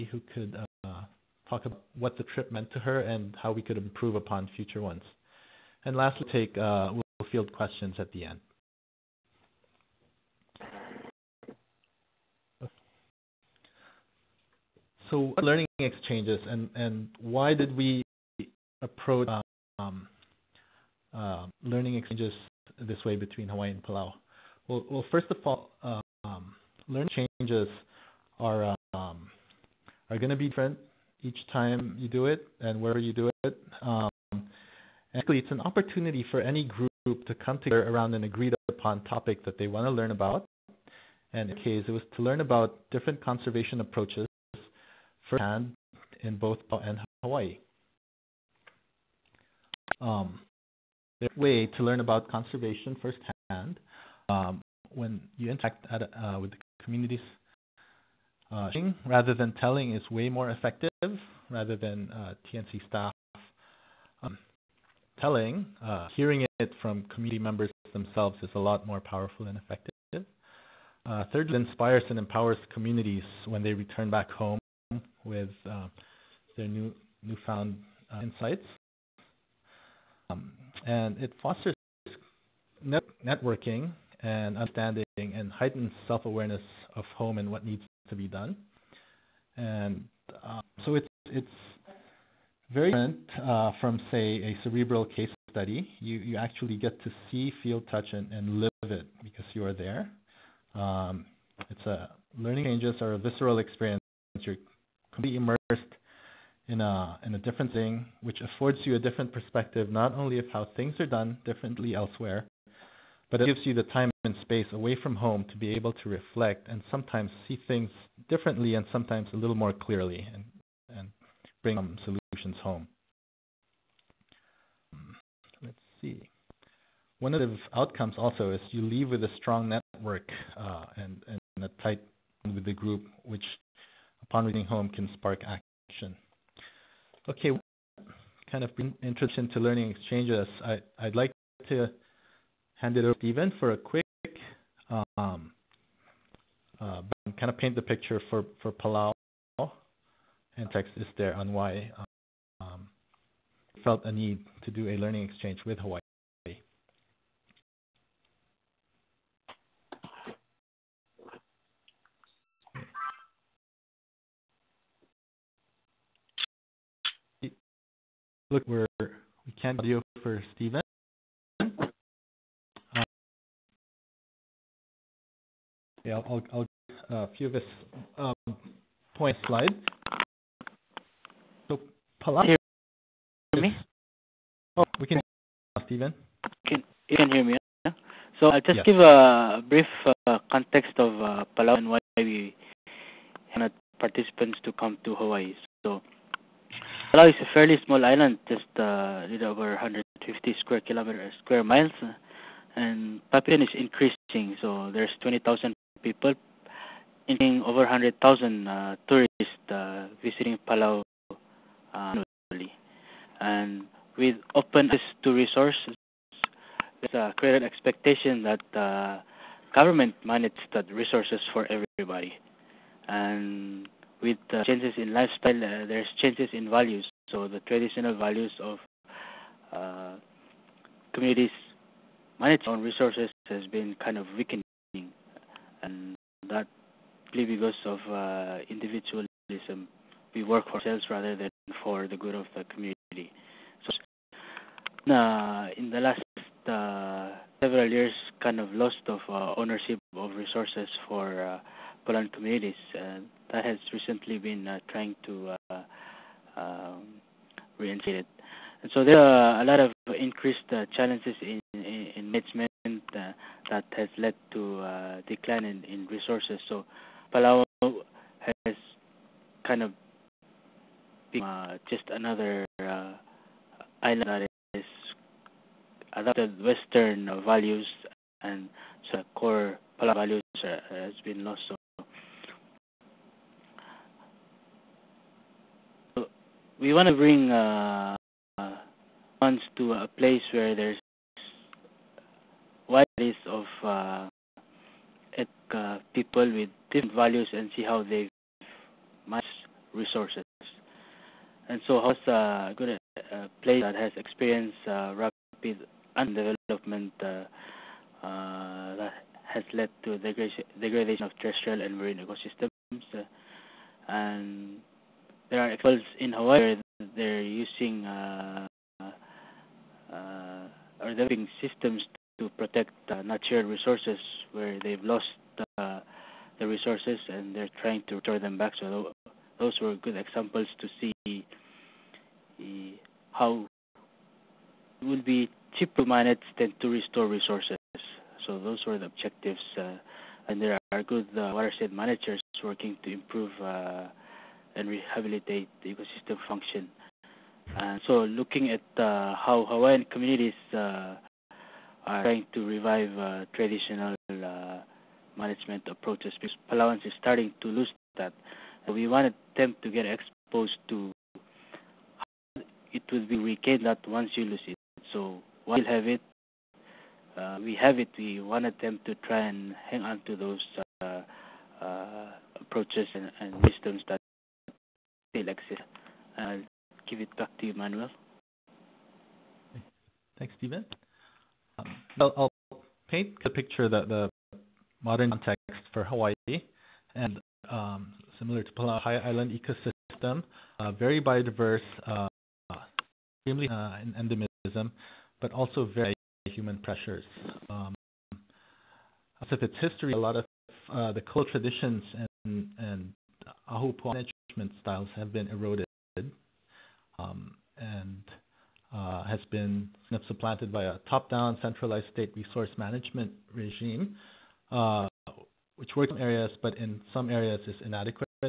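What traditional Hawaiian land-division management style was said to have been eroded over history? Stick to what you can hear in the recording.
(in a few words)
ahupua'a.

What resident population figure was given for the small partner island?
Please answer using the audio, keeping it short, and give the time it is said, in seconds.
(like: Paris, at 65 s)
20,000, at 205 s.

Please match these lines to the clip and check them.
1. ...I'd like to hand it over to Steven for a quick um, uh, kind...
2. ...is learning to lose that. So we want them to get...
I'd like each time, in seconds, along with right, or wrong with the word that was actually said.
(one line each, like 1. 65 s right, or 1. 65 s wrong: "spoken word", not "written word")
1. 140 s right
2. 357 s wrong: "starting", not "learning".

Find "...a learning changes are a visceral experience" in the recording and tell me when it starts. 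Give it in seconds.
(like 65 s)
101 s.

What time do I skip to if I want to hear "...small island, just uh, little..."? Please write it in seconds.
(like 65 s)
197 s.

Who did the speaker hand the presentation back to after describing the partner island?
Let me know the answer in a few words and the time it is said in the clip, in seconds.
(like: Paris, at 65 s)
Manuel, at 377 s.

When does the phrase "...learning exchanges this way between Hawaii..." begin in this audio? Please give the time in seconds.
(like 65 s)
21 s.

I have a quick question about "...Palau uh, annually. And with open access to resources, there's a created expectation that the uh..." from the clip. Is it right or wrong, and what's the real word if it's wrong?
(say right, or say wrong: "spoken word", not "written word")
right.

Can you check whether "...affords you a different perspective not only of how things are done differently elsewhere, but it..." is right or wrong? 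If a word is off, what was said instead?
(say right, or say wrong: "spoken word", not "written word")
right.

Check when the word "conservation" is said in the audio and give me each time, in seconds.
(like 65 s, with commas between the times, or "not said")
43 s, 52 s.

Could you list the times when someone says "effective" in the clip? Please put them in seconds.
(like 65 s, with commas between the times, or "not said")
60 s, 69 s.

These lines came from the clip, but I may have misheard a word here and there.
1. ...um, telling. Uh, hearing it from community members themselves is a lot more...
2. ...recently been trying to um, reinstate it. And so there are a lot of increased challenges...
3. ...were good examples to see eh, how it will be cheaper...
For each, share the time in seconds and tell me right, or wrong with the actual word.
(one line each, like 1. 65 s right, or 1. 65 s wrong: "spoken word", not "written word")
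1. 64 s right
2. 253 s right
3. 329 s right.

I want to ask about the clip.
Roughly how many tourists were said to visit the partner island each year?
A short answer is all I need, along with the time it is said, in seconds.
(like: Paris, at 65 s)
over 100,000, at 207 s.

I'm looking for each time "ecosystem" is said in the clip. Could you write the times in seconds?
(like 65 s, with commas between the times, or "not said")
312 s, 345 s, 389 s.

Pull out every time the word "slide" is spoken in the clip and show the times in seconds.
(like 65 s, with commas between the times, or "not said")
179 s.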